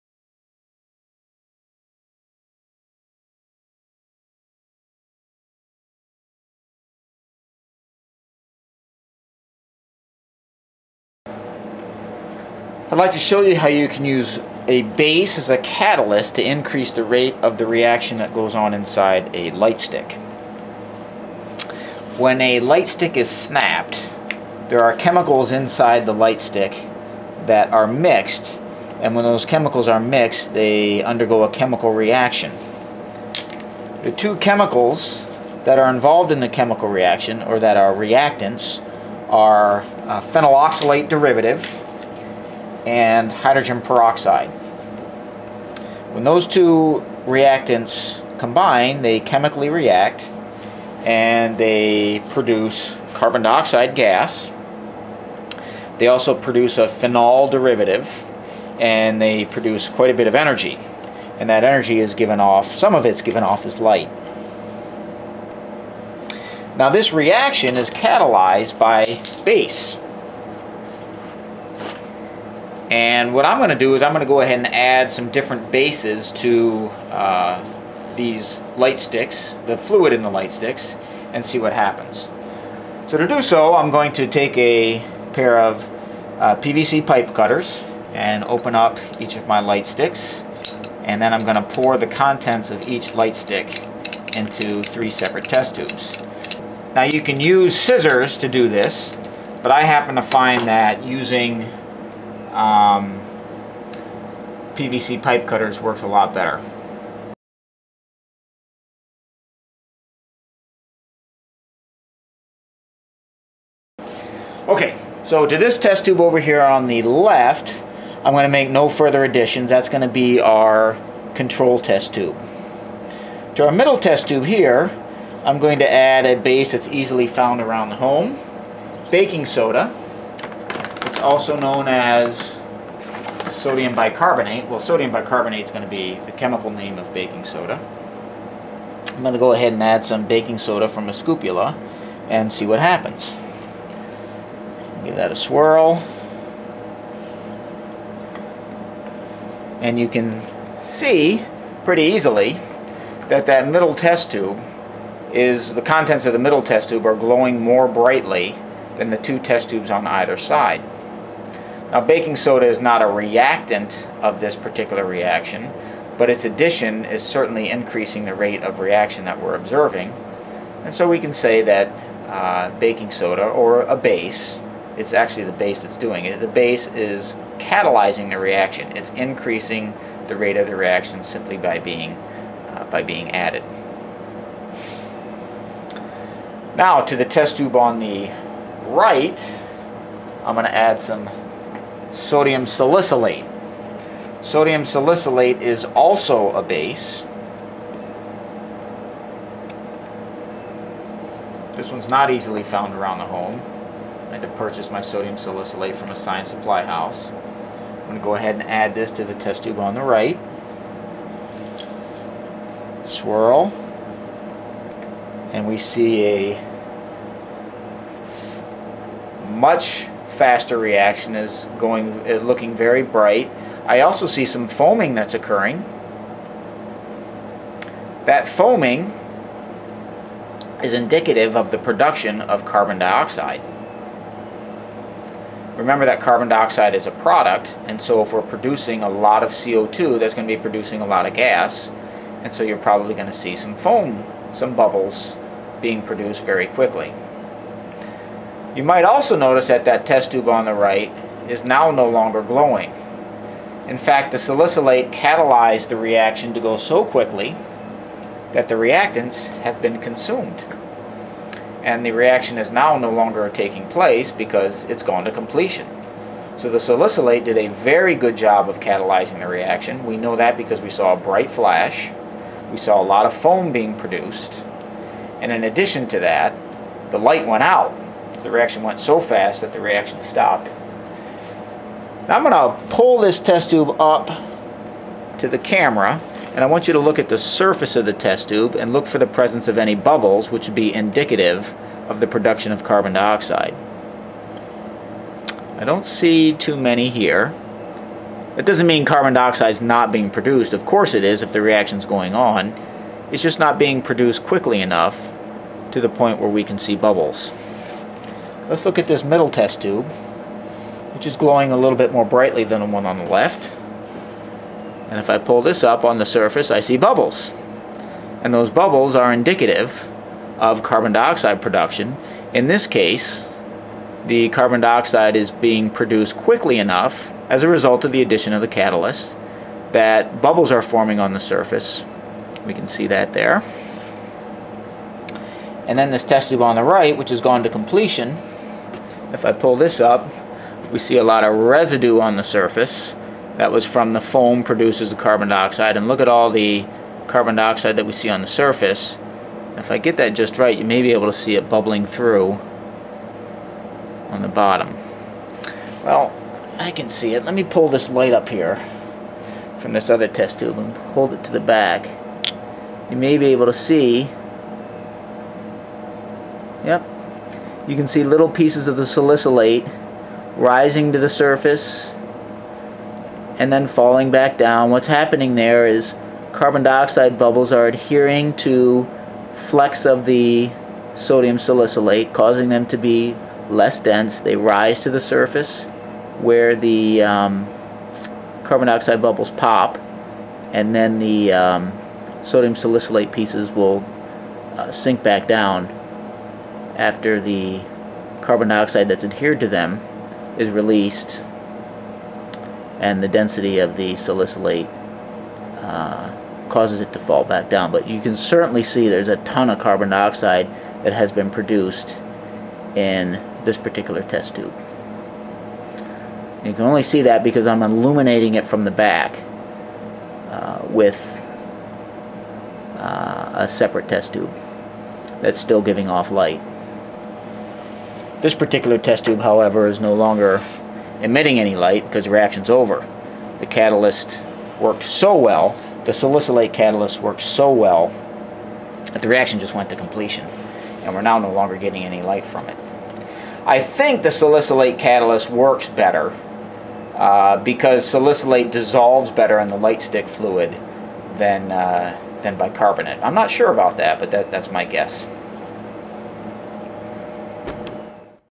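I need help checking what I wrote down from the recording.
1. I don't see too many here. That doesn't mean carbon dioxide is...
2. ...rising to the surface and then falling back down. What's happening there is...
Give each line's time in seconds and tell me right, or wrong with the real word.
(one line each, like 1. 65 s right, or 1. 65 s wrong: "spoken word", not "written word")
1. 295 s right
2. 370 s right.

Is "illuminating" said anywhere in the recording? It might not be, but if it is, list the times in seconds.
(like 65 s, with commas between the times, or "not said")
417 s.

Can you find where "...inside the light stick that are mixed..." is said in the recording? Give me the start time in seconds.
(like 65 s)
25 s.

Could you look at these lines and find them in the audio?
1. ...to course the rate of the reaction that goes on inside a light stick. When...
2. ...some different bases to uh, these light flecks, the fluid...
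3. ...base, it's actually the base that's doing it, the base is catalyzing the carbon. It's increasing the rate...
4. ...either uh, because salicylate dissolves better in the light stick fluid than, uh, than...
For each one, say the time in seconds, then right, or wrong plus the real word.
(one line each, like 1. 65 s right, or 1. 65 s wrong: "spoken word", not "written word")
1. 16 s wrong: "increase", not "course"
2. 75 s wrong: "sticks", not "flecks"
3. 173 s wrong: "reaction", not "carbon"
4. 445 s wrong: "better", not "either".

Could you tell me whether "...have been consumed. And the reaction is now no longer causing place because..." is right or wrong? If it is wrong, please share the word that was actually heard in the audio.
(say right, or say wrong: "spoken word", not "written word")
wrong: "taking", not "causing".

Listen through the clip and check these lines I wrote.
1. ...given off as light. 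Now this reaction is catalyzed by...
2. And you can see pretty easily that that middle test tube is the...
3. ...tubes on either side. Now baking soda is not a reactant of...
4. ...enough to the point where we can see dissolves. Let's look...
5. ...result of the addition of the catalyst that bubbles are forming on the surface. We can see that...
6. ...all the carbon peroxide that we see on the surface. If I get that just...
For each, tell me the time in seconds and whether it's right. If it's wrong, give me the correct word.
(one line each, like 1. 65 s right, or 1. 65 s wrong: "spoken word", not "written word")
1. 63 s right
2. 149 s right
3. 159 s right
4. 304 s wrong: "bubbles", not "dissolves"
5. 327 s right
6. 346 s wrong: "dioxide", not "peroxide".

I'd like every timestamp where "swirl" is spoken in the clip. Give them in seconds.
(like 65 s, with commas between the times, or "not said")
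145 s, 213 s.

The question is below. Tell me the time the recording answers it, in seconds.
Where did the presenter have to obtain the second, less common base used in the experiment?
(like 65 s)
206 s.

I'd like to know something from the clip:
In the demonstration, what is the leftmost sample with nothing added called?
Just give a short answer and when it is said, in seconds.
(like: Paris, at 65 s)
control test tube, at 121 s.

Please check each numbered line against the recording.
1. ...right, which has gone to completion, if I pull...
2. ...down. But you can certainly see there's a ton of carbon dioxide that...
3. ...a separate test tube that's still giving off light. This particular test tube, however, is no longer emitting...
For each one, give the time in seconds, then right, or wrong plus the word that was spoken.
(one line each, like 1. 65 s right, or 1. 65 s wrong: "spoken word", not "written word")
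1. 336 s right
2. 407 s right
3. 423 s right.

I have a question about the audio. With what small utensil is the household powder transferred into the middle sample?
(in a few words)
scoopula.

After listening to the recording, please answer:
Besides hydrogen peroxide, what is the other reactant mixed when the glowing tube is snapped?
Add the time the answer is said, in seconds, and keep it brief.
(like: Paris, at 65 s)
phenyl oxalate derivative, at 40 s.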